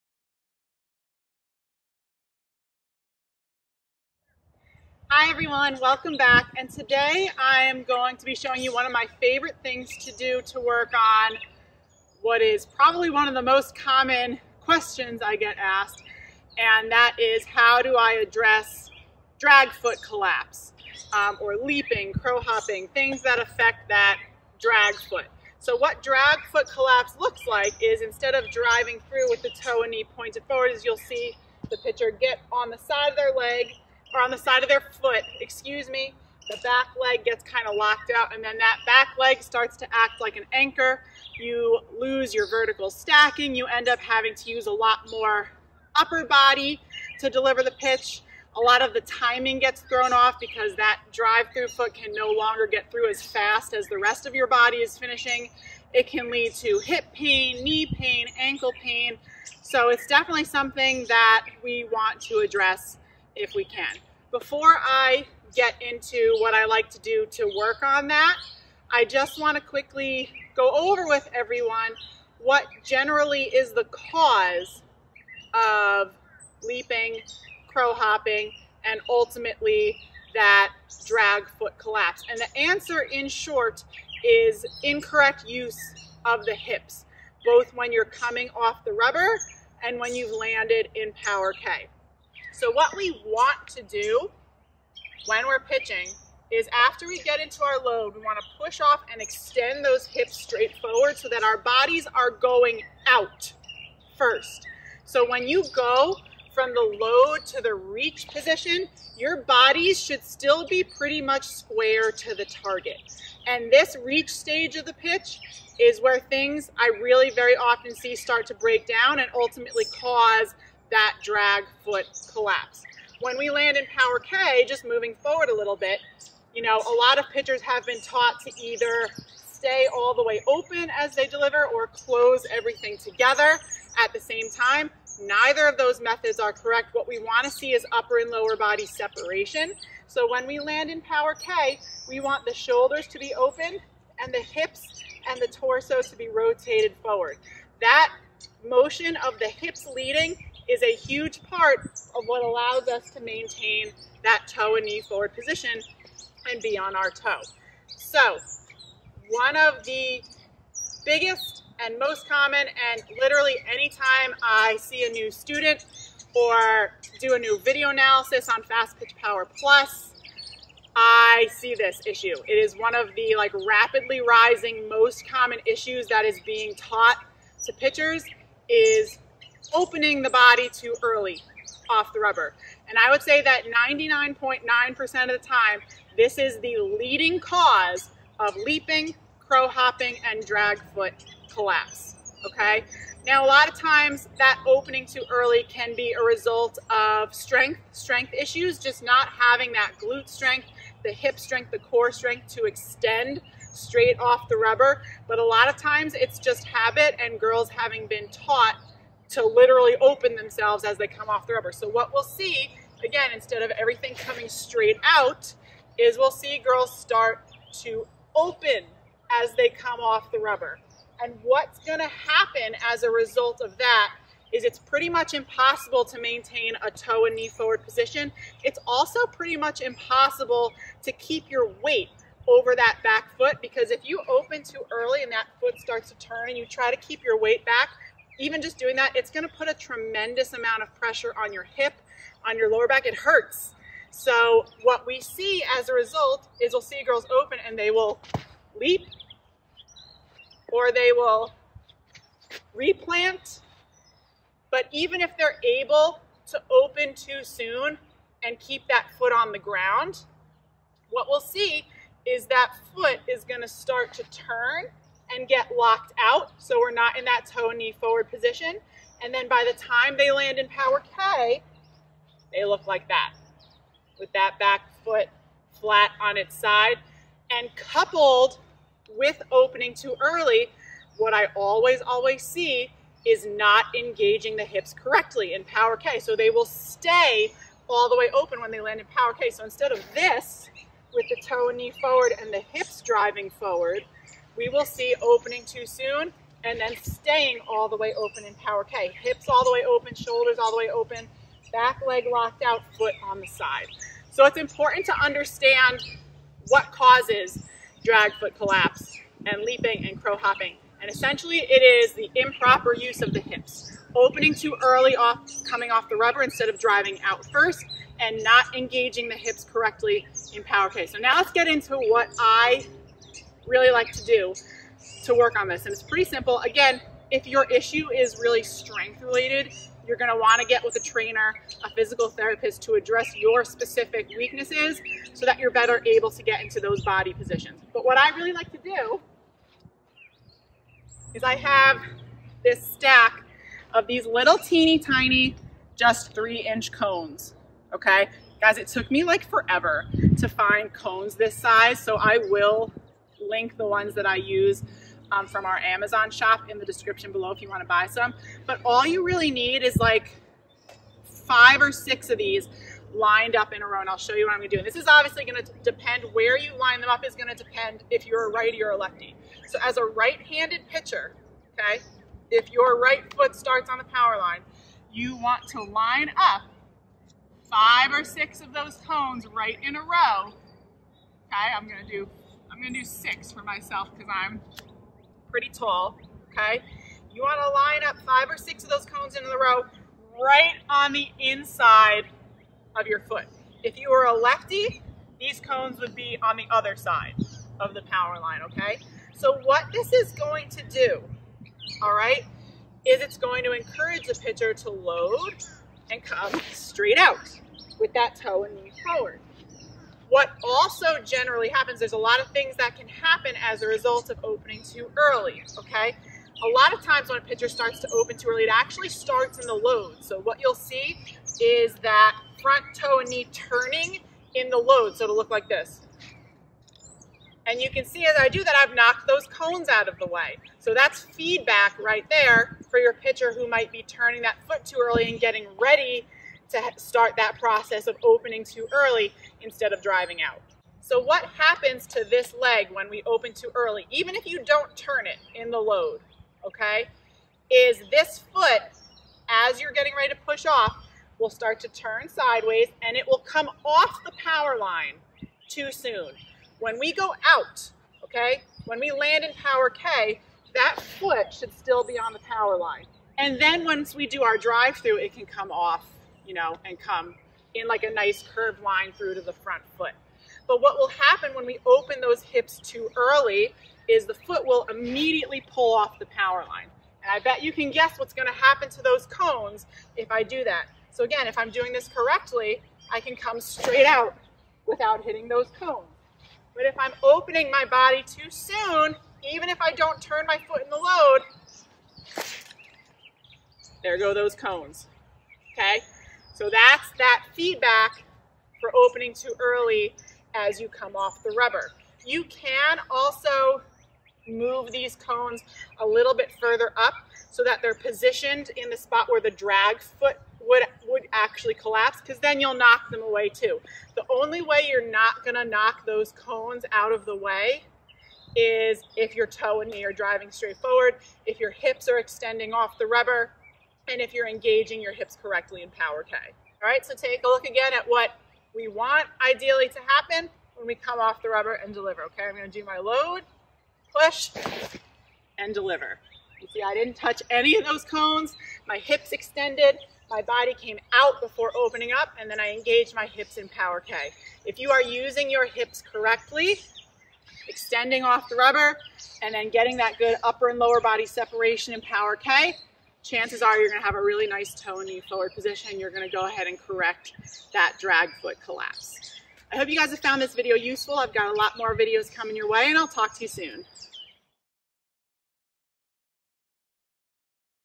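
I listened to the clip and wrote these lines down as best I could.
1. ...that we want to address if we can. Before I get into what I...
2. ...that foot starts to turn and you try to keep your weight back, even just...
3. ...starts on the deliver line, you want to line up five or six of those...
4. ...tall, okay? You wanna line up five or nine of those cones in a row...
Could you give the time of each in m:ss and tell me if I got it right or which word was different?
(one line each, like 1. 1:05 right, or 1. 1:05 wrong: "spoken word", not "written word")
1. 1:01 right
2. 3:55 right
3. 6:13 wrong: "power", not "deliver"
4. 6:25 wrong: "six", not "nine".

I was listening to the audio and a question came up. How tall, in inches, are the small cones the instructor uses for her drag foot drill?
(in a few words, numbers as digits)
3 inches.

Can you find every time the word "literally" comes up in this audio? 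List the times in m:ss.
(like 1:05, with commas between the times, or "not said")
2:43, 3:29.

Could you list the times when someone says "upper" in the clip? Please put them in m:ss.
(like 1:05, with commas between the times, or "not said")
0:45, 2:17, 9:10.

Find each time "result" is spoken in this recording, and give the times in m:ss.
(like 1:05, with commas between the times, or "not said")
3:16, 3:43, 4:05, 6:53.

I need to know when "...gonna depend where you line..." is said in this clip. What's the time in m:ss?
6:05.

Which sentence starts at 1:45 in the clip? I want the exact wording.
So when you go from the load to the reach position, your bodies should still be pretty much square to the target.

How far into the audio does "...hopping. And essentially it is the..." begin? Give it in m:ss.
5:10.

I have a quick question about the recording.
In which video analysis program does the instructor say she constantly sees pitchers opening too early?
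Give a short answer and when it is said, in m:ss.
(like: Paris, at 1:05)
Fastpitch Power Plus, at 2:48.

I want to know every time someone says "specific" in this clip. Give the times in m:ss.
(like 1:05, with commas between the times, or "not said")
5:33.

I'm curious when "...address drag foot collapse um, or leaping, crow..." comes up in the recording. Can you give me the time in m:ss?
0:18.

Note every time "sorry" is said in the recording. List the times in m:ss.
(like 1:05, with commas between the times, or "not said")
not said.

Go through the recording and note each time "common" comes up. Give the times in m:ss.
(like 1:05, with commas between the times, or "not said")
0:13, 2:42, 2:55.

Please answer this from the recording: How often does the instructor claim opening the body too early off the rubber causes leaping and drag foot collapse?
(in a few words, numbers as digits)
99.9%.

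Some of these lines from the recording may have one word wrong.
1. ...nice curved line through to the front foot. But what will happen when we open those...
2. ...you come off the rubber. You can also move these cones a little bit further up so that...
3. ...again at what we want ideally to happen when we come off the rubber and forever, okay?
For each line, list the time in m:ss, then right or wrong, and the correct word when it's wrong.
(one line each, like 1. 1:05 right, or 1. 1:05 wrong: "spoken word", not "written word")
1. 7:48 right
2. 8:20 right
3. 8:47 wrong: "deliver", not "forever".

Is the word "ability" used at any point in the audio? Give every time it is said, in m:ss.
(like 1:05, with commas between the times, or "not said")
not said.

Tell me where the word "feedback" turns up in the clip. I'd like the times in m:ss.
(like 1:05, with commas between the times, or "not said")
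7:11, 8:17.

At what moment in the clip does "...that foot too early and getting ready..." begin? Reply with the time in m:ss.
7:14.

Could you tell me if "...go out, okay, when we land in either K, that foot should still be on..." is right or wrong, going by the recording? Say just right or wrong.
wrong.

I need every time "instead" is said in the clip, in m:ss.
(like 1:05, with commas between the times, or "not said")
0:27, 3:33, 4:49, 5:16, 7:19.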